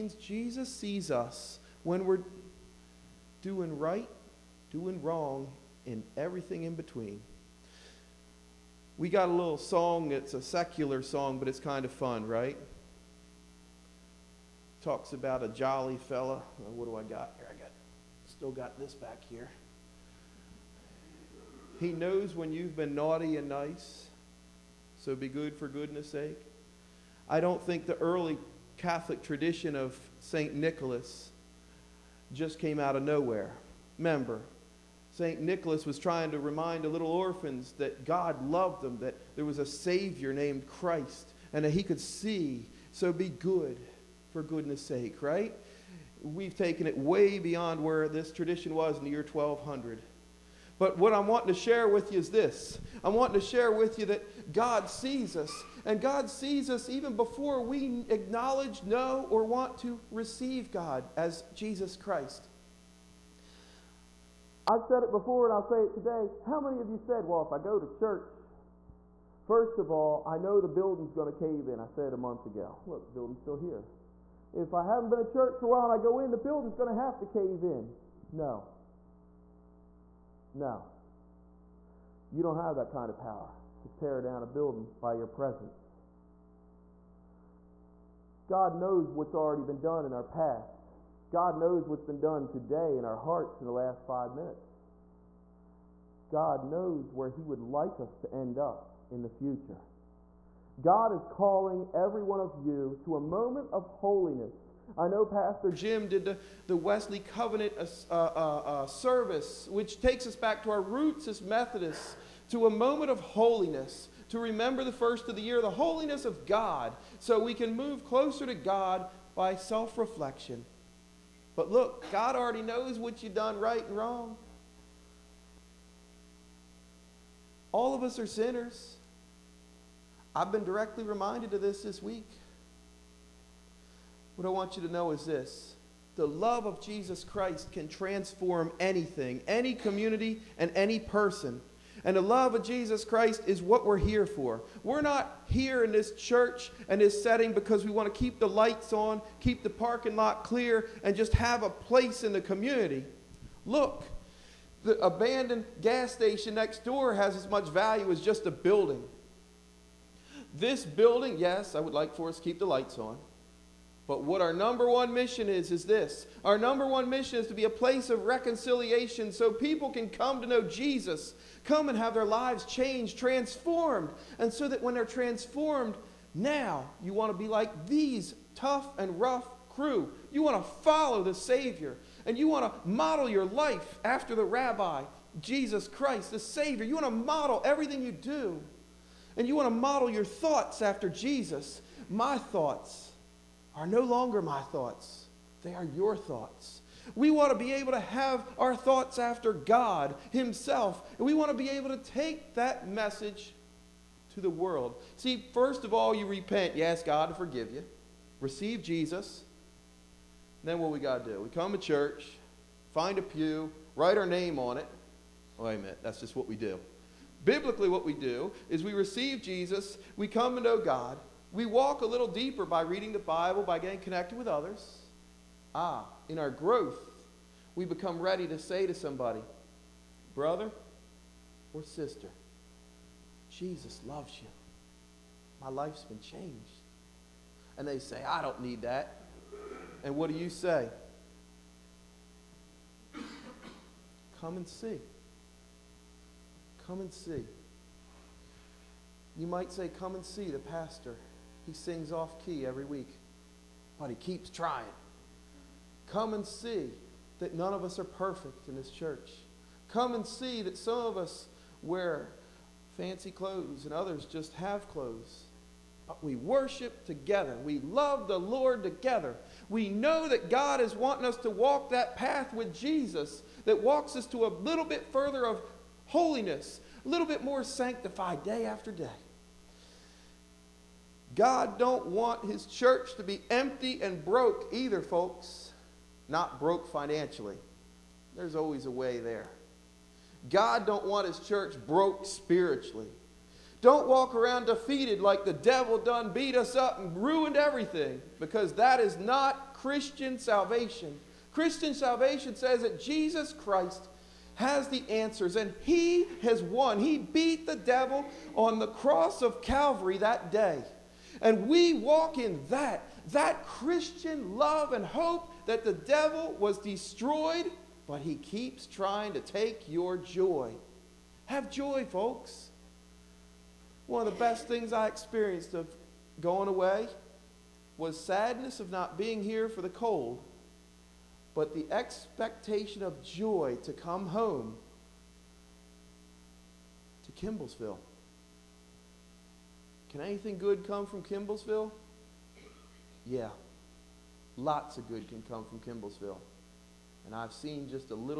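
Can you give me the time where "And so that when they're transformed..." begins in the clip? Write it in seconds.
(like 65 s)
174 s.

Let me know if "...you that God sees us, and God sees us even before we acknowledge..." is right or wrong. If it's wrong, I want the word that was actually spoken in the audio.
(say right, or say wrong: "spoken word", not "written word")
right.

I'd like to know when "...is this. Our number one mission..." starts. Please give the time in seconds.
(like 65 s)
165 s.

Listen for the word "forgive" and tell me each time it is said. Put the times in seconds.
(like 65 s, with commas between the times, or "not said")
207 s.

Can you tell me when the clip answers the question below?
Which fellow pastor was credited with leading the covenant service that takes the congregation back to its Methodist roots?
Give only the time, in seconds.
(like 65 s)
105 s.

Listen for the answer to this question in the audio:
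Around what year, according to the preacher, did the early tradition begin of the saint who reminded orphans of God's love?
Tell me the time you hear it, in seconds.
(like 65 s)
49 s.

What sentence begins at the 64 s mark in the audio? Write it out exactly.
I've said it before and I'll say it today.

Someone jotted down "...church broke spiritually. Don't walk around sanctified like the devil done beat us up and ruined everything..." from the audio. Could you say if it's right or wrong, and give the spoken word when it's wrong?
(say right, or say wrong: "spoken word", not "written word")
wrong: "defeated", not "sanctified".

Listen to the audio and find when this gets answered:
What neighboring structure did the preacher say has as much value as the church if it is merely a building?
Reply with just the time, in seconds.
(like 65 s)
155 s.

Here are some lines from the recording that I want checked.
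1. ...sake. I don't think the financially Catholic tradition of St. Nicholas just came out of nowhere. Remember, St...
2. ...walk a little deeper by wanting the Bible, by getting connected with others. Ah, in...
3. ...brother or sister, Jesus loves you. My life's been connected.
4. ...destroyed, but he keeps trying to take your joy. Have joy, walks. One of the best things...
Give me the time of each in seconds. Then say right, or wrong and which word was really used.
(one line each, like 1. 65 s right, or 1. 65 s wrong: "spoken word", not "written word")
1. 26 s wrong: "early", not "financially"
2. 221 s wrong: "reading", not "wanting"
3. 230 s wrong: "changed", not "connected"
4. 316 s wrong: "folks", not "walks".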